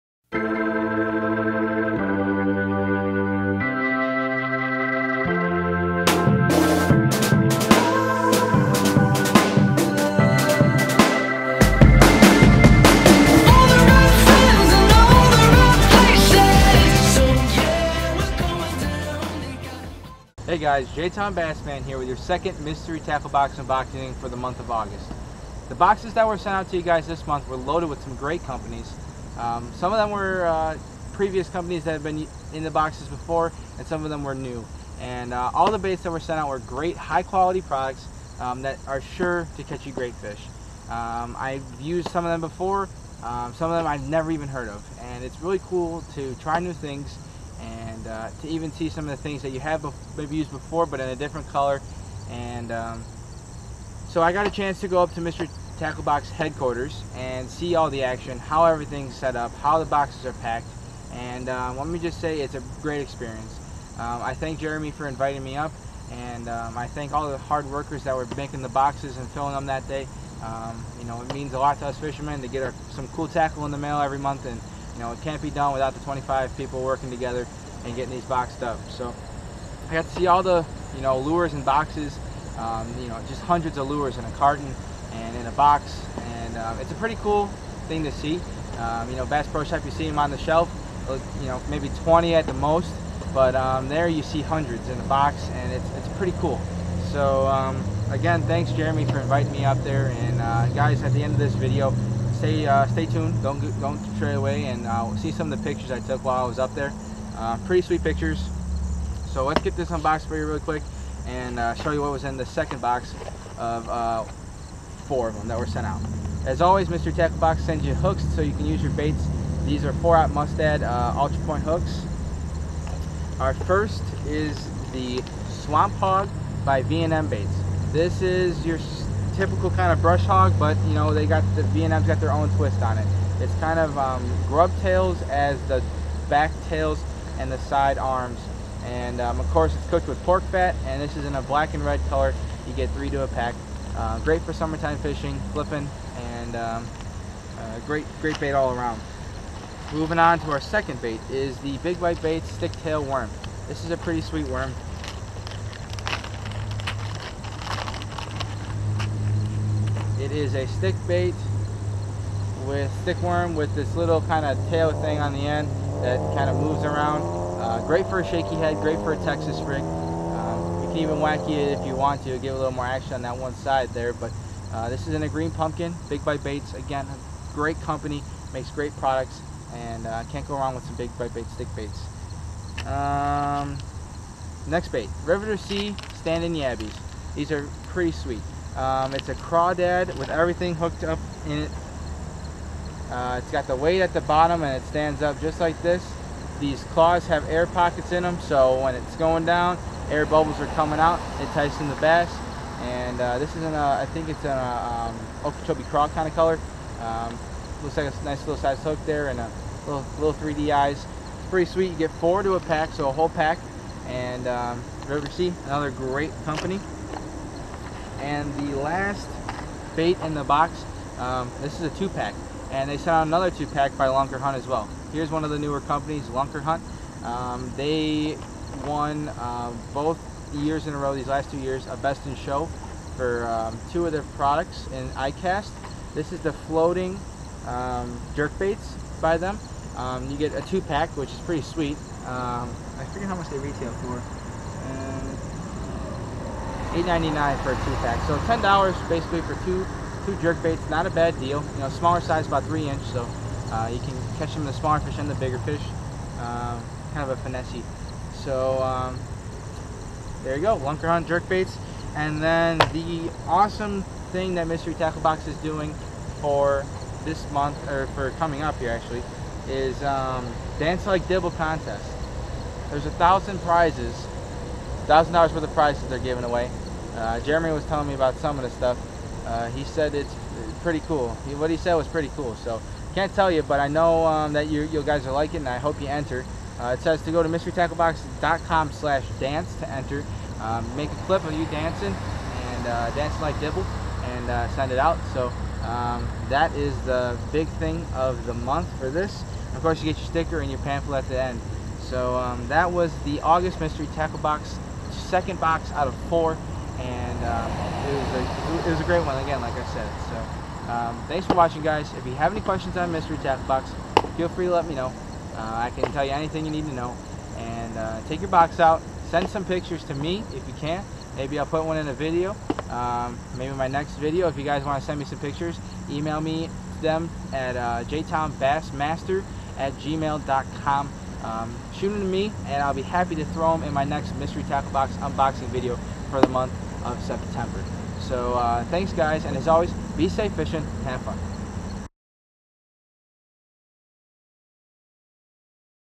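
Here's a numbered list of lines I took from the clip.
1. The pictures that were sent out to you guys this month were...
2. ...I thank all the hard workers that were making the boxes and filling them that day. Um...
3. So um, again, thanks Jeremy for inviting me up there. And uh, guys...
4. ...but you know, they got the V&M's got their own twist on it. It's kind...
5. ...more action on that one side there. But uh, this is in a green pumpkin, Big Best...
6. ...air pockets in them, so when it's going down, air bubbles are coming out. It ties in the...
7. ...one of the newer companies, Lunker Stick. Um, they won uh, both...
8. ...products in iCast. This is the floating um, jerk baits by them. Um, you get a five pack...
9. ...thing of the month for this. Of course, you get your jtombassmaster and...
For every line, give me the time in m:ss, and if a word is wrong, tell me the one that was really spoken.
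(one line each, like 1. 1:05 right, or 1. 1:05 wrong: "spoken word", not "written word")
1. 0:25 wrong: "boxes", not "pictures"
2. 1:06 right
3. 1:37 right
4. 2:10 right
5. 2:52 wrong: "Bite", not "Best"
6. 3:17 right
7. 3:45 wrong: "Hunt", not "Stick"
8. 3:54 wrong: "two", not "five"
9. 4:57 wrong: "sticker", not "jtombassmaster".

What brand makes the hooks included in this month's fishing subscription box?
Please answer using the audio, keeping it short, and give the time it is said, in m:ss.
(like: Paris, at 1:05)
Mustad, at 2:00.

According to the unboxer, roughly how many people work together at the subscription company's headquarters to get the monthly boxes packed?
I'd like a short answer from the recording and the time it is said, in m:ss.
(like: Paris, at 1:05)
25, at 1:16.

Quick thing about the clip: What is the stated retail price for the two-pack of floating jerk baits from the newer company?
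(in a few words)
$8.99.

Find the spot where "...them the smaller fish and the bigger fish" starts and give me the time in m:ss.
4:14.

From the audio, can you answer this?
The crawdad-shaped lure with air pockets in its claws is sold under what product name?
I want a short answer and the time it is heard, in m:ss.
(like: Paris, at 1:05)
Standing Yabbies, at 3:06.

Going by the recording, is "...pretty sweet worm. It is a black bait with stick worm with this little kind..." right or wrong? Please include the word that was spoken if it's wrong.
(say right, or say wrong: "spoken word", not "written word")
wrong: "stick", not "black".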